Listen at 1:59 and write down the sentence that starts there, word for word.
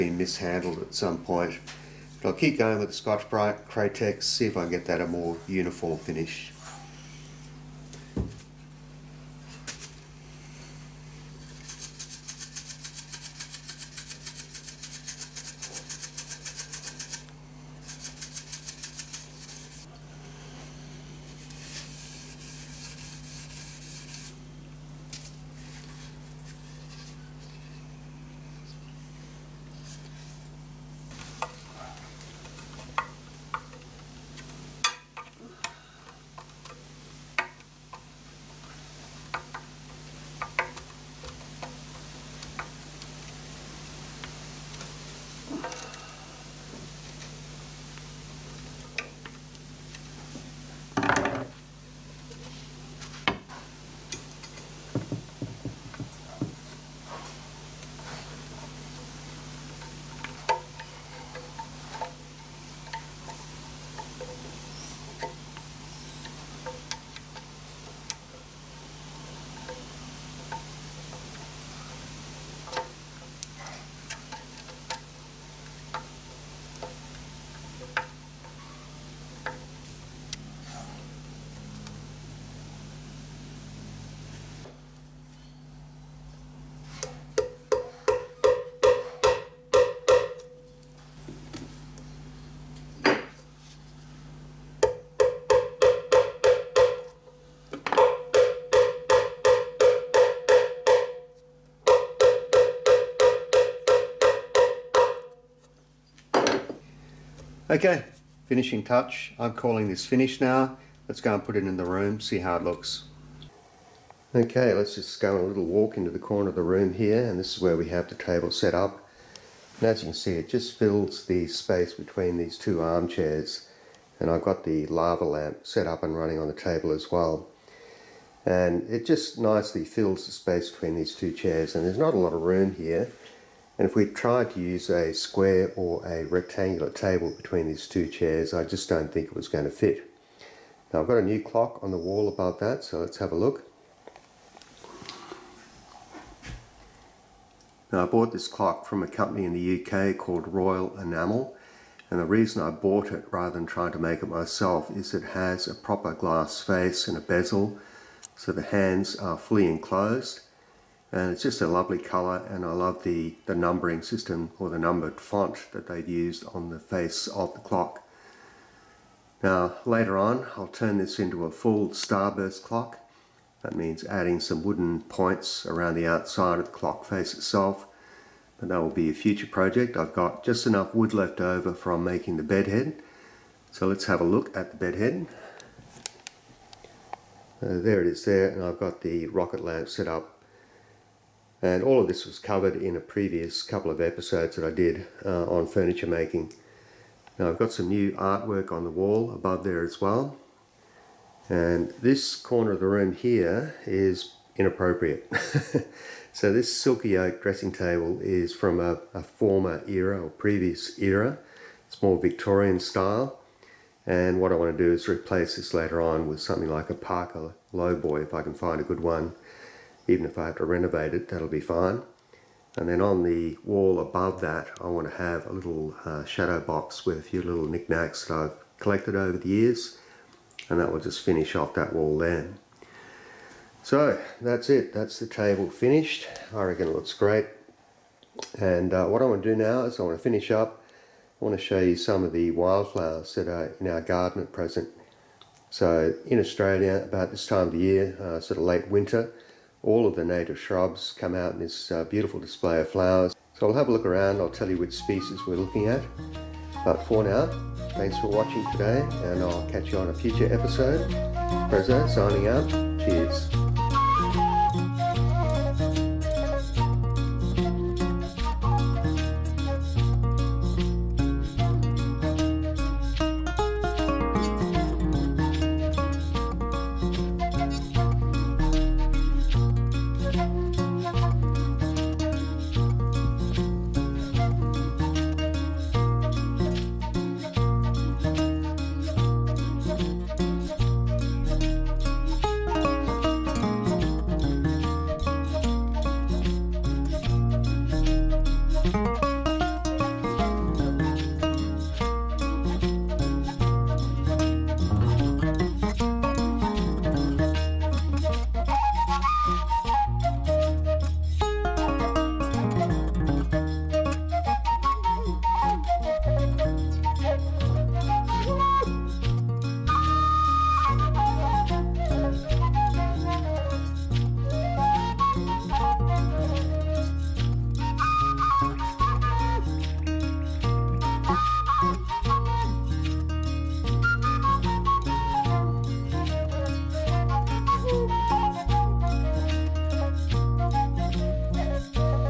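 And as you can see, it just fills the space between these two armchairs.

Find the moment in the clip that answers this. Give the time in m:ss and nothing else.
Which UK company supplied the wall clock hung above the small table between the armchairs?
2:30.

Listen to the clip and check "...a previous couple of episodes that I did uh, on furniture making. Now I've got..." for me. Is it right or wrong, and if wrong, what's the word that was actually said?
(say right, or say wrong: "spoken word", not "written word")
right.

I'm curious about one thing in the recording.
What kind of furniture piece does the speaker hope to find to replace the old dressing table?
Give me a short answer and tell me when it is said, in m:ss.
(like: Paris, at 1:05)
Parker Lowboy, at 3:36.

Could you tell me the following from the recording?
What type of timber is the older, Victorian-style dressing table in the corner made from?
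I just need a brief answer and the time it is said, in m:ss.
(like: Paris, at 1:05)
silky oak, at 3:26.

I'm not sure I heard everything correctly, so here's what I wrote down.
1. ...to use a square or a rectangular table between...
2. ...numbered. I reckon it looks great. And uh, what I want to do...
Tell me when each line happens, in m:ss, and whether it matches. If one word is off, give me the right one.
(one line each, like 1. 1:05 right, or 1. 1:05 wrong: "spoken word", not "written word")
1. 2:14 right
2. 3:55 wrong: "finished", not "numbered".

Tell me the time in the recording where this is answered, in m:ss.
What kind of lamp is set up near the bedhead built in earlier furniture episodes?
3:09.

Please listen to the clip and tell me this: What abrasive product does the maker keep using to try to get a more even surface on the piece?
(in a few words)
Scotch-Brite.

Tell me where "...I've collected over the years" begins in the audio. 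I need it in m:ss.
3:48.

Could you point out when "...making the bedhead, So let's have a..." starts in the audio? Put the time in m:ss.
3:02.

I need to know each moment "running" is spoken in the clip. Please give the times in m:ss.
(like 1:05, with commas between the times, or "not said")
2:06.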